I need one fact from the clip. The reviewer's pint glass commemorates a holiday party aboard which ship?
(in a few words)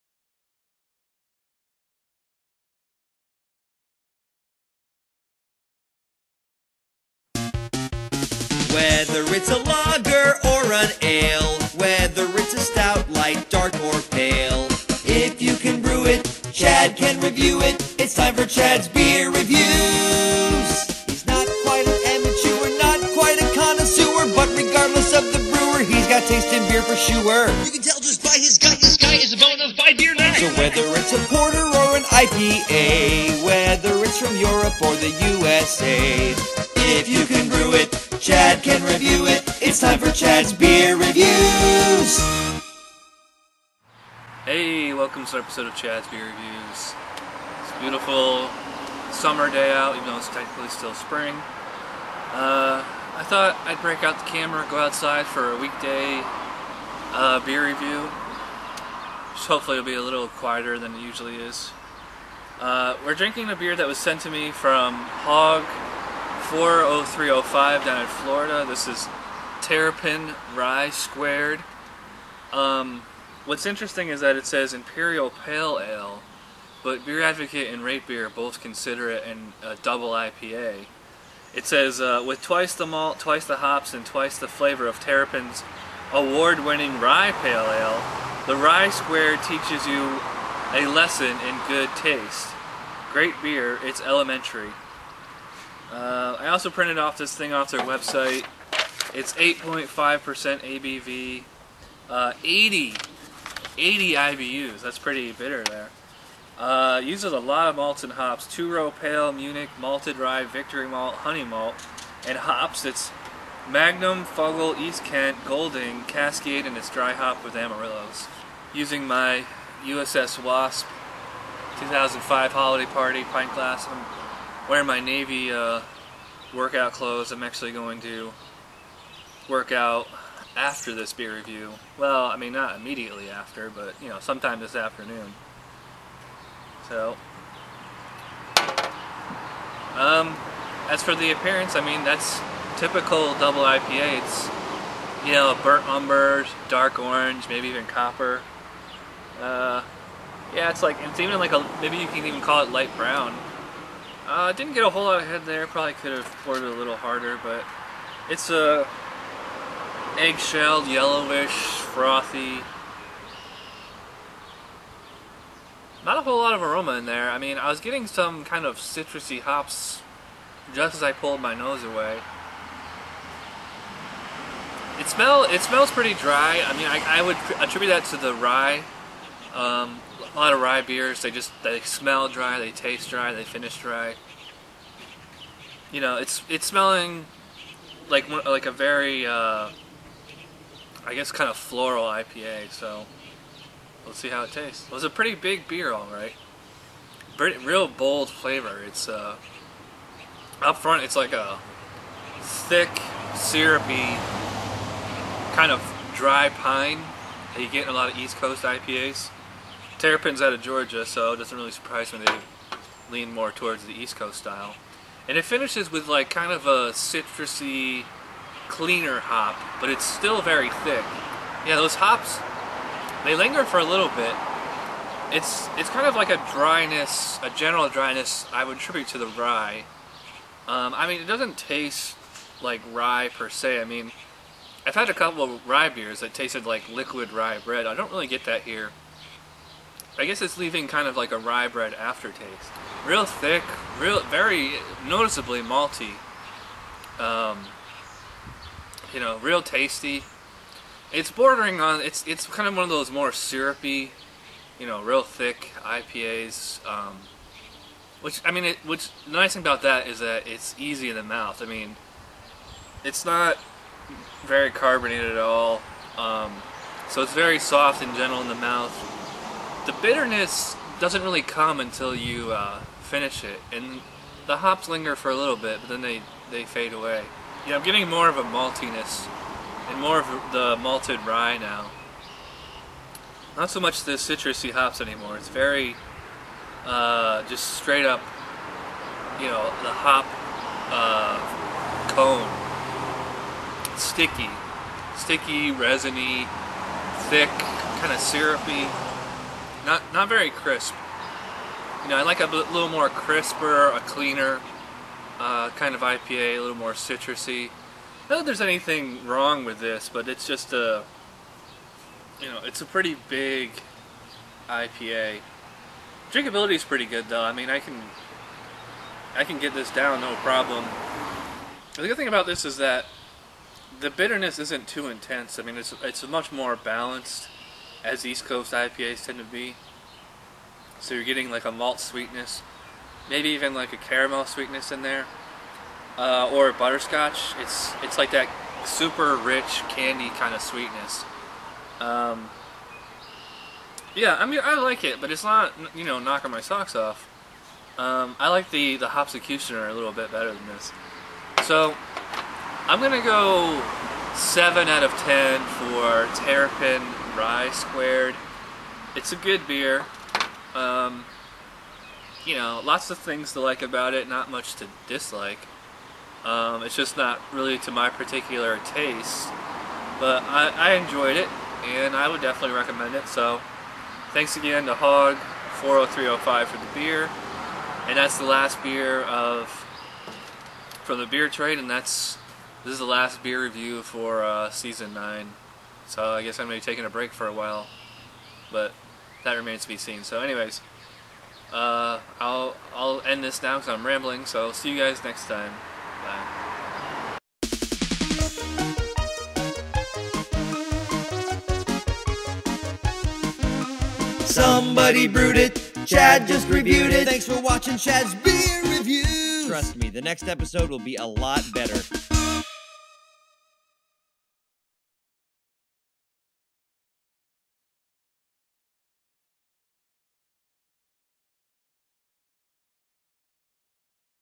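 USS Wasp.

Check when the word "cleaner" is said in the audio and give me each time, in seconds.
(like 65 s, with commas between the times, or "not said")
218 s, 304 s.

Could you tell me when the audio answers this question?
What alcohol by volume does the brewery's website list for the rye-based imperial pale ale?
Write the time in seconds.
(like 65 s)
99 s.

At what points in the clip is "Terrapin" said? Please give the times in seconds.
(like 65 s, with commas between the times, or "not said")
69 s, 84 s, 210 s, 356 s.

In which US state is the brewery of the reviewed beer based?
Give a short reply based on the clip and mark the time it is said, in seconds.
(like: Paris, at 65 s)
Georgia, at 210 s.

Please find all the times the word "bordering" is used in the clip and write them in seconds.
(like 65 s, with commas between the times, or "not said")
251 s.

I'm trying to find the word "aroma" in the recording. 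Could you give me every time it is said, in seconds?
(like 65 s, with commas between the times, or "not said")
166 s.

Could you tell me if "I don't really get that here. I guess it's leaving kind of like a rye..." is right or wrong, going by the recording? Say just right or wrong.
right.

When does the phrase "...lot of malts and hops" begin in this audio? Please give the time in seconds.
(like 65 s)
107 s.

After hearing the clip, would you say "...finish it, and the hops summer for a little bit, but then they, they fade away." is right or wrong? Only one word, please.
wrong.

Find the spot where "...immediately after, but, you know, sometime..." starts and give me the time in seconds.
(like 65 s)
132 s.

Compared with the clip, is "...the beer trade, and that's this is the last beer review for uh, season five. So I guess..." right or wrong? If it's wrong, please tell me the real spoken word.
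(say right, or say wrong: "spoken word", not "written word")
wrong: "nine", not "five".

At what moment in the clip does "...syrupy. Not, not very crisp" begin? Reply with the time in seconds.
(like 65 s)
298 s.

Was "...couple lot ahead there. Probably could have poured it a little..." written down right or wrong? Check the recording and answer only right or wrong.
wrong.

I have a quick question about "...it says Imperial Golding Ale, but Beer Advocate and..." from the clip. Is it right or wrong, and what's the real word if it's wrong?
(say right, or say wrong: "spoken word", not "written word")
wrong: "Pale", not "Golding".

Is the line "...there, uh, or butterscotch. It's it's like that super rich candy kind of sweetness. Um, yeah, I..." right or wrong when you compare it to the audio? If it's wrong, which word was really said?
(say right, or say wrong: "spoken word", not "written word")
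right.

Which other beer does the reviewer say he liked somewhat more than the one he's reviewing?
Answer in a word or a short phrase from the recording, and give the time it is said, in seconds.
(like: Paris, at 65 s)
Hopsecutioner, at 349 s.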